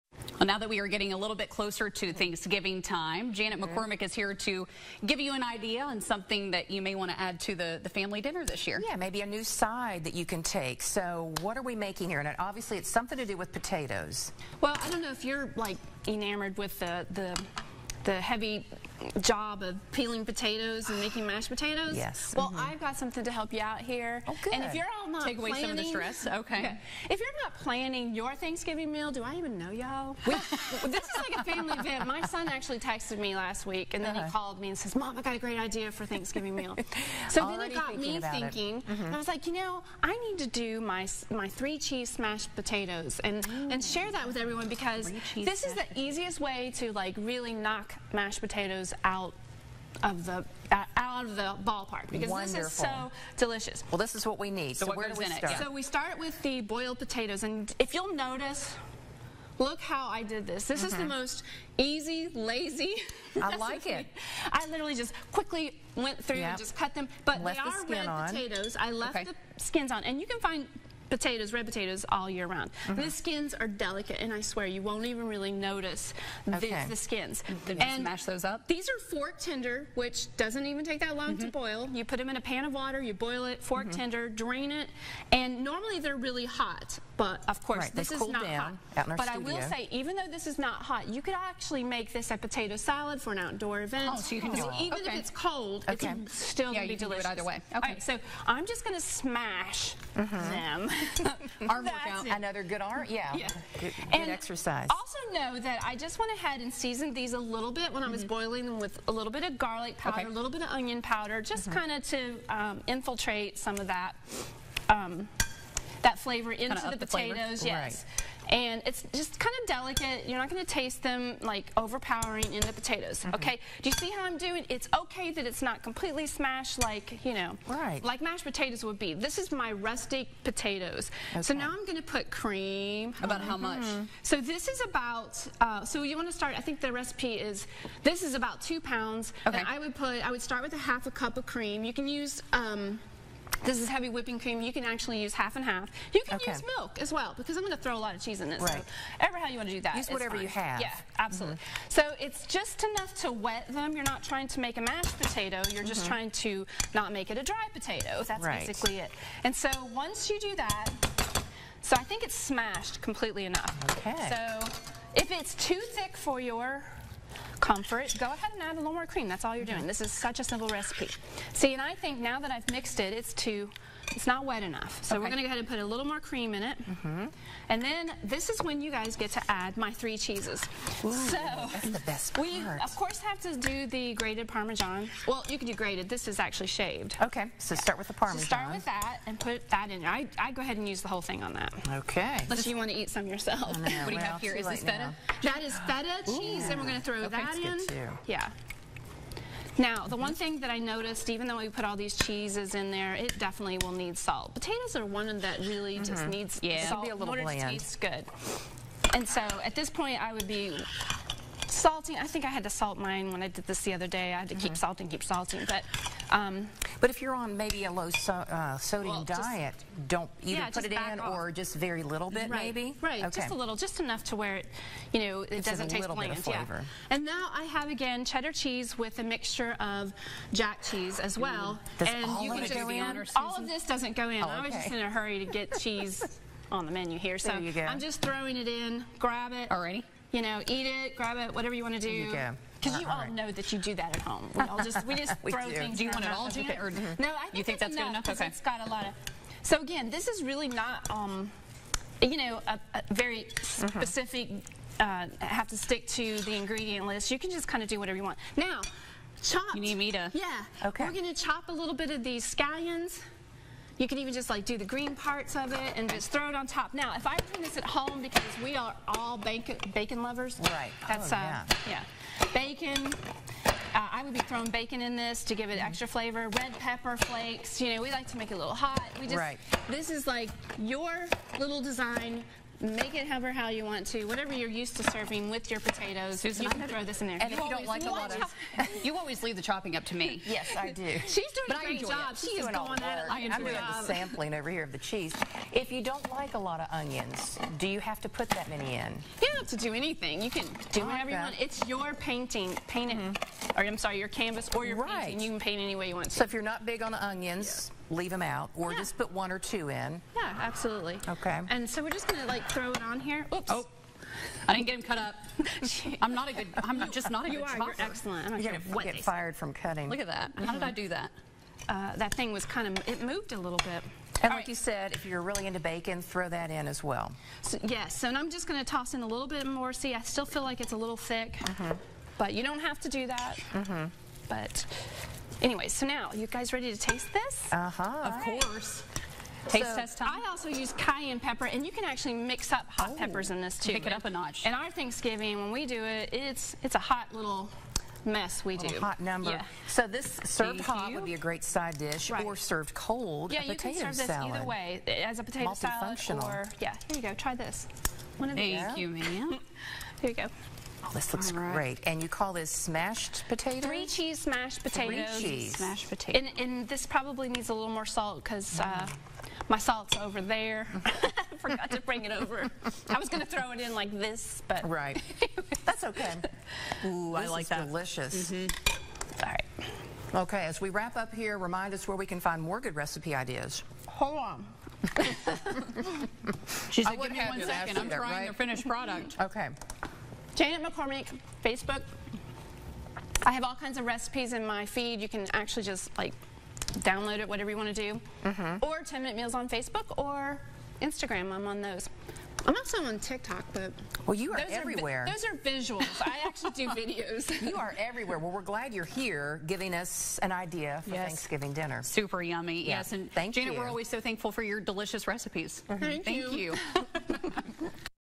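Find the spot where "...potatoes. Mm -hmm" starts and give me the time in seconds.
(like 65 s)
122 s.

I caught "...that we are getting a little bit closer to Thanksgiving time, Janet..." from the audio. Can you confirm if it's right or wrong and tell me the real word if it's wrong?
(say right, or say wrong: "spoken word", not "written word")
right.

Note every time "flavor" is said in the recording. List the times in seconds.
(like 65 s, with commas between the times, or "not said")
116 s, 276 s.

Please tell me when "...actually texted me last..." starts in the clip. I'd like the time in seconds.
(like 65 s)
32 s.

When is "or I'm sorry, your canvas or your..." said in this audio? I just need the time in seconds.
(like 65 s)
303 s.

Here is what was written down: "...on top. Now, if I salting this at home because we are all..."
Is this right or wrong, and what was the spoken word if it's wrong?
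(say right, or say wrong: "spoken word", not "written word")
wrong: "bring", not "salting".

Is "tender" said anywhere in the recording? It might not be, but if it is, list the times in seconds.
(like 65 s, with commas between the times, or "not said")
79 s, 84 s.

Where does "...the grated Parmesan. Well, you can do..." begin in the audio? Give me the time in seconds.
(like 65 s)
183 s.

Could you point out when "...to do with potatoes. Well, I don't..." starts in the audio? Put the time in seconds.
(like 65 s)
13 s.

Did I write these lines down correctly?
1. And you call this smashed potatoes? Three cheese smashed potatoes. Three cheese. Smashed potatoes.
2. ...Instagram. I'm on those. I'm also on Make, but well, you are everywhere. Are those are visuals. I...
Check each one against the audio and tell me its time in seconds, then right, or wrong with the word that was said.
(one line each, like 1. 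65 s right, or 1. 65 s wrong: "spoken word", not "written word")
1. 362 s right
2. 401 s wrong: "TikTok", not "Make".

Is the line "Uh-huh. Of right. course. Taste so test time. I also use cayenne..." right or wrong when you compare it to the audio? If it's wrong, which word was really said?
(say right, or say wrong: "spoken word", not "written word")
right.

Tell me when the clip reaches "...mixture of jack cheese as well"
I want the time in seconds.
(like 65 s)
229 s.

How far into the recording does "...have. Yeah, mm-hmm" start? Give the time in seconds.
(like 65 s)
150 s.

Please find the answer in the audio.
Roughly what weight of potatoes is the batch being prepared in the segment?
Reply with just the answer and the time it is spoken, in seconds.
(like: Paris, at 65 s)
2 pounds, at 138 s.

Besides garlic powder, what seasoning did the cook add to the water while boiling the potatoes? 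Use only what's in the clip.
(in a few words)
onion powder.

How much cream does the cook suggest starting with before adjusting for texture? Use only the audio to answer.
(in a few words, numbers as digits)
half a cup.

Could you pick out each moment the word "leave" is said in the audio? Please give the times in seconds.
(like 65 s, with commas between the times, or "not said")
289 s, 308 s.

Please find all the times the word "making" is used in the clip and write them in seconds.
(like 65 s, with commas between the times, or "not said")
11 s, 20 s.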